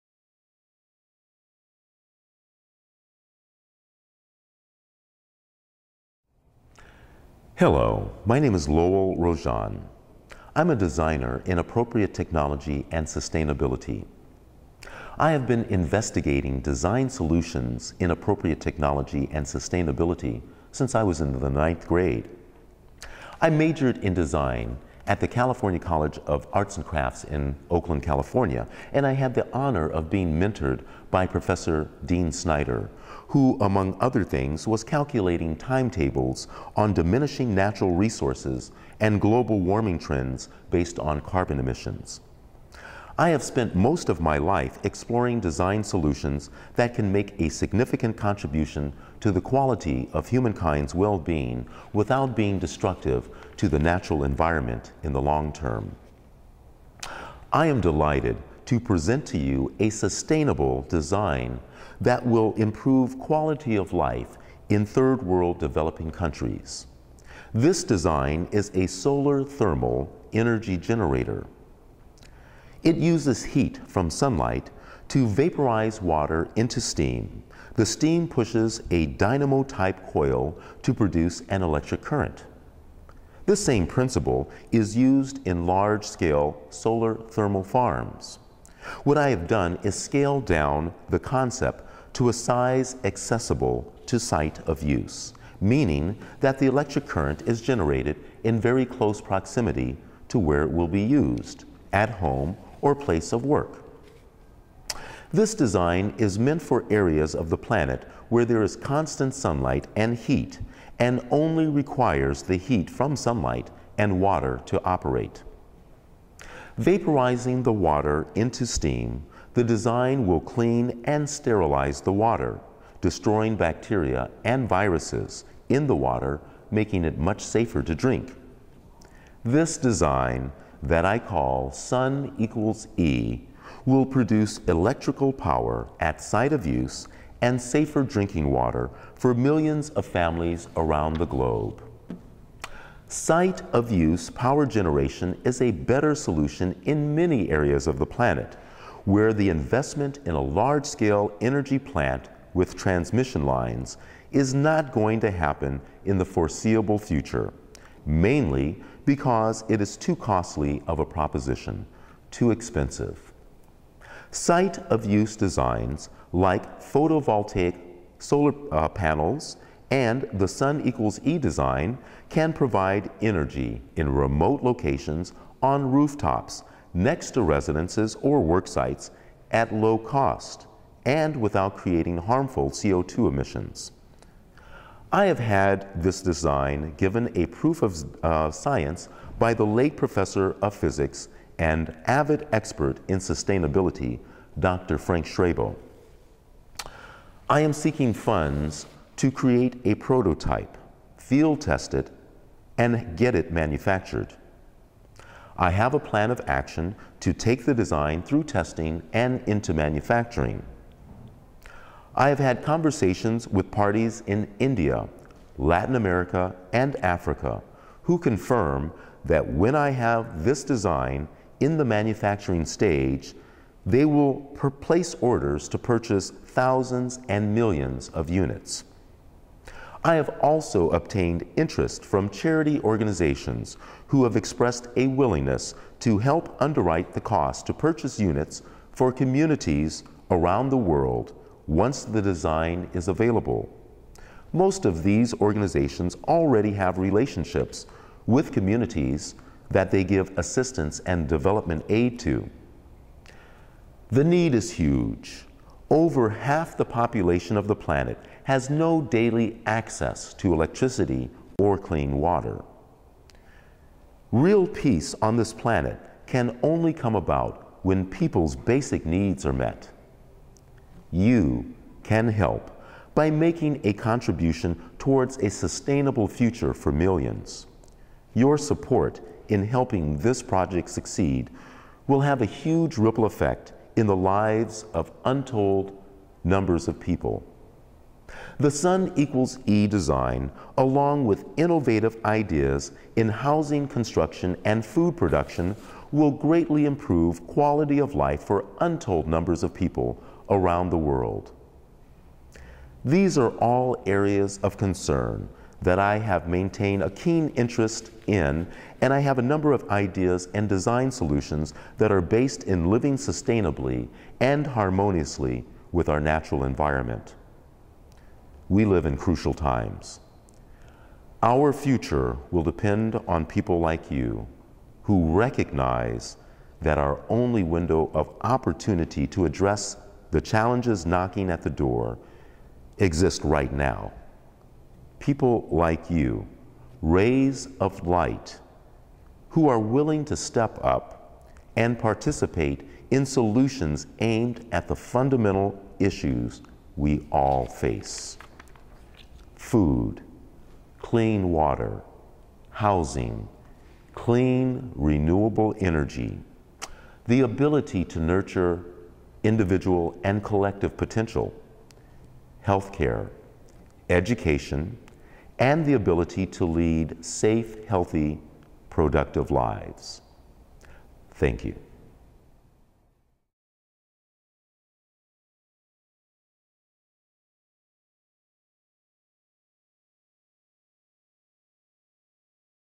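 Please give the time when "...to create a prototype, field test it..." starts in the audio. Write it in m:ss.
3:19.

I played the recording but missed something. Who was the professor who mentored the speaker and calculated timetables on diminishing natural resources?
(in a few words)
Dean Snyder.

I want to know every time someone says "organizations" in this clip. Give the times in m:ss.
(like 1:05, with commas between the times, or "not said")
3:52, 4:05.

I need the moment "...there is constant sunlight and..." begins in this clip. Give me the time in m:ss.
1:48.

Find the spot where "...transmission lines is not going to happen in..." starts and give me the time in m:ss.
2:32.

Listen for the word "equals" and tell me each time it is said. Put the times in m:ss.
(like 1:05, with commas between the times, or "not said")
2:12, 2:50, 4:49.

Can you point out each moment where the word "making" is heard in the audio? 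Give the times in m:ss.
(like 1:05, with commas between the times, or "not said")
2:06, 4:33.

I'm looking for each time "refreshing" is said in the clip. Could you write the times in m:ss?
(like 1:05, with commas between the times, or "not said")
not said.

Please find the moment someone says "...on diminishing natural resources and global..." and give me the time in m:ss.
0:36.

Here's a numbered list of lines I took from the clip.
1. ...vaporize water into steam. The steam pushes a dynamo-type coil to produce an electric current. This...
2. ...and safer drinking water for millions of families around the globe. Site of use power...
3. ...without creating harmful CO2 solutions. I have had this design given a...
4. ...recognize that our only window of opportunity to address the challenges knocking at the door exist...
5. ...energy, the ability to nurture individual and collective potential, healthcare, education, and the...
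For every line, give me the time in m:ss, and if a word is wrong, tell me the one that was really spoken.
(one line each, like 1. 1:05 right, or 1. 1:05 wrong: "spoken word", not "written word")
1. 1:15 right
2. 2:17 right
3. 3:01 wrong: "emissions", not "solutions"
4. 5:25 right
5. 5:55 right.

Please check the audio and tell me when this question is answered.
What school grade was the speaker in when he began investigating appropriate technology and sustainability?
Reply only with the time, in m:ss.
0:21.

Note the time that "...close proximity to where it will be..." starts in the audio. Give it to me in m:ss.
1:38.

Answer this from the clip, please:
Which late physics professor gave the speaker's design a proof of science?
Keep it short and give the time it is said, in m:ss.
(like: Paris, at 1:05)
Frank Schrabel, at 3:14.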